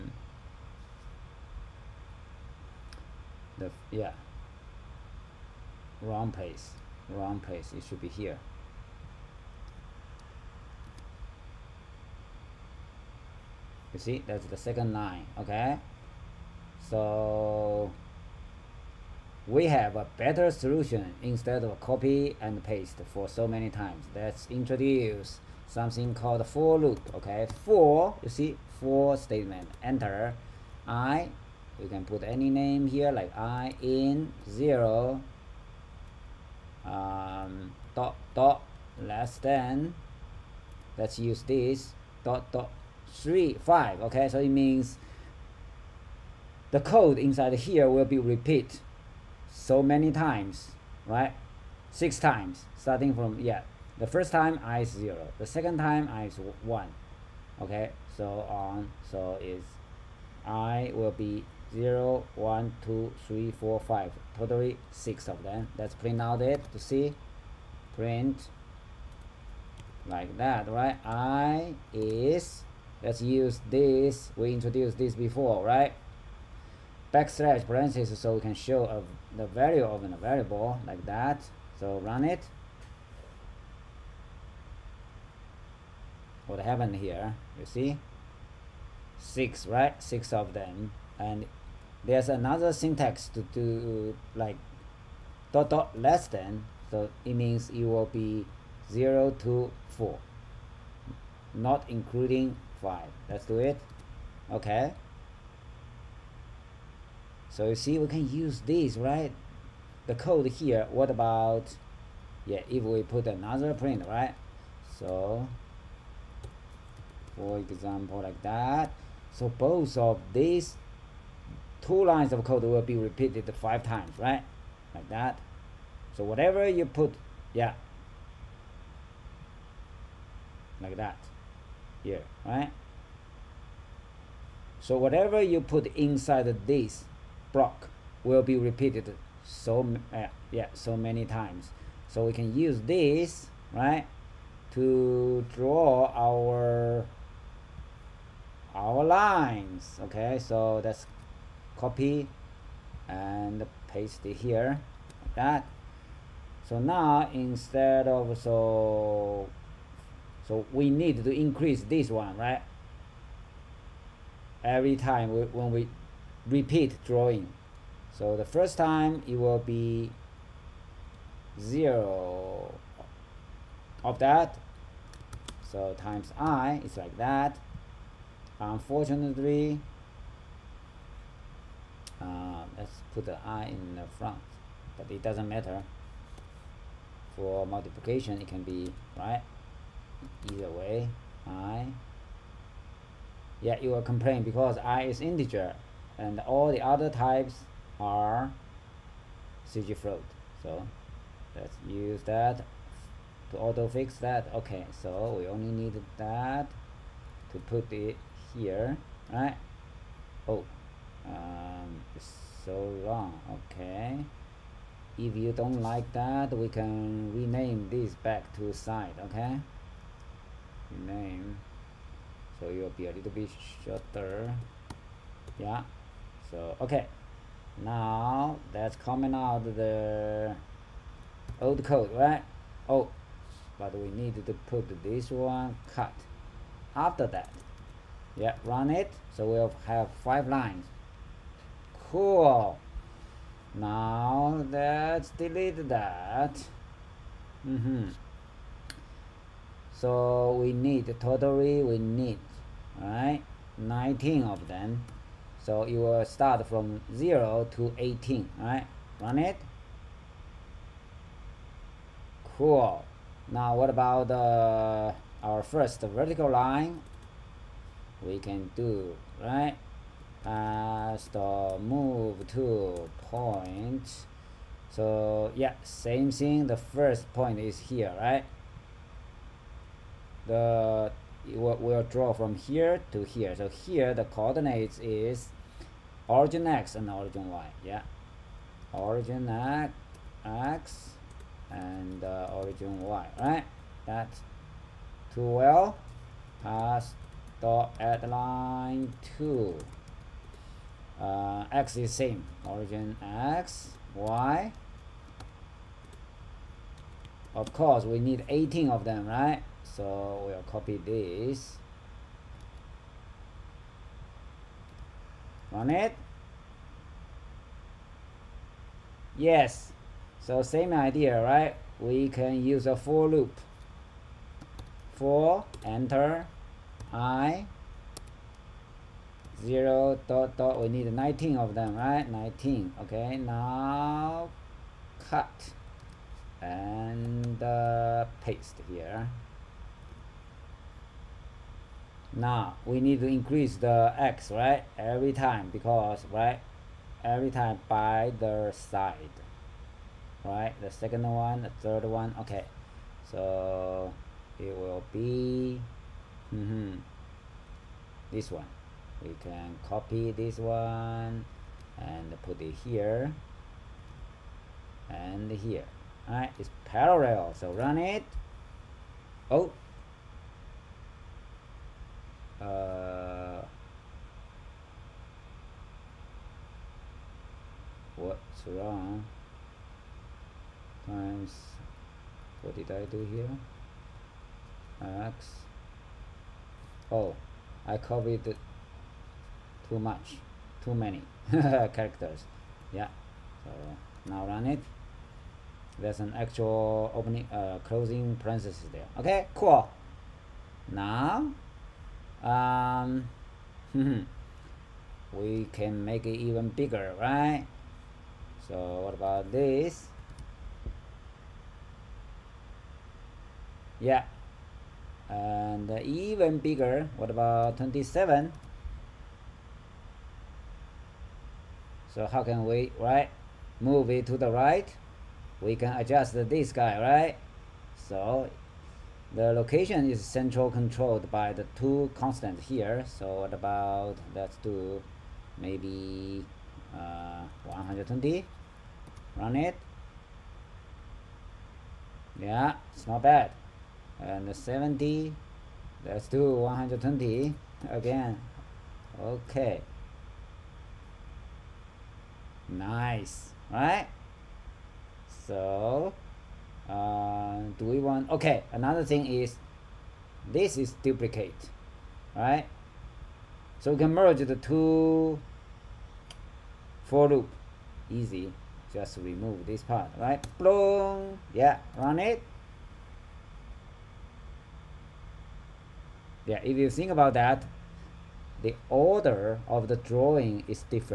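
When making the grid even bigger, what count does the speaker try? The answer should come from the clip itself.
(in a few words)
27.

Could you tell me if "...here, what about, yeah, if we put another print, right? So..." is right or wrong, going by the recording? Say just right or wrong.
right.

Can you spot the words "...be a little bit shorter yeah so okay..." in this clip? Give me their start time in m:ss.
3:42.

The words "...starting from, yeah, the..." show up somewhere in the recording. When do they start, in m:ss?
0:52.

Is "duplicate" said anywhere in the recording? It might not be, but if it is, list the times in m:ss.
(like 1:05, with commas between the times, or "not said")
7:41.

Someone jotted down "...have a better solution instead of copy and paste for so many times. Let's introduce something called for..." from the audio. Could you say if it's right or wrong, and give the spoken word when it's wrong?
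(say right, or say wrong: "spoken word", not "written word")
right.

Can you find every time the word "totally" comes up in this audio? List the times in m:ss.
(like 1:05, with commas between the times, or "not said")
1:04, 4:11.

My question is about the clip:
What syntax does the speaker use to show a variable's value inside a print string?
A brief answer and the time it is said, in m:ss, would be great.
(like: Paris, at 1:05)
Backslash parentheses, at 1:17.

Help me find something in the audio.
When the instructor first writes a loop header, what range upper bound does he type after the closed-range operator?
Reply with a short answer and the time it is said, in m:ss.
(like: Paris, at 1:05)
5, at 0:42.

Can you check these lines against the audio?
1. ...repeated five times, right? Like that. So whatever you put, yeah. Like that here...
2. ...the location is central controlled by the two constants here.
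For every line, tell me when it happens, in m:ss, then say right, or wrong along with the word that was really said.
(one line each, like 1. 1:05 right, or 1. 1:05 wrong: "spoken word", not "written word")
1. 2:02 right
2. 7:09 right.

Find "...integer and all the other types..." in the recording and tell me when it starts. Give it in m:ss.
3:15.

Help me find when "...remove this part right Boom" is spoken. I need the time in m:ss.
7:49.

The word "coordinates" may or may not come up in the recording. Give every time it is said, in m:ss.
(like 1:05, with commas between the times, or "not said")
4:44.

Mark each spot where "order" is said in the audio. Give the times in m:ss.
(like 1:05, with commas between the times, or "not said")
7:58.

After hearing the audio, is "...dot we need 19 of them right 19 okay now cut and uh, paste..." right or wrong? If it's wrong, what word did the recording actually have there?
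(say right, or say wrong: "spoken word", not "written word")
right.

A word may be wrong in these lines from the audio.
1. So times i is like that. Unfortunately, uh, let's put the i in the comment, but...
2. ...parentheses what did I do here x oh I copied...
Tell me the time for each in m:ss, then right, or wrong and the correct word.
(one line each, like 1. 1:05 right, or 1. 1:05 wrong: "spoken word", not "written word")
1. 2:55 wrong: "front", not "comment"
2. 6:21 wrong: "times", not "parentheses".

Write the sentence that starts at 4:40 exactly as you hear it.
the will, will draw from here to here.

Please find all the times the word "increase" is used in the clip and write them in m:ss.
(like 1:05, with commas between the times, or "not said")
2:41, 5:43.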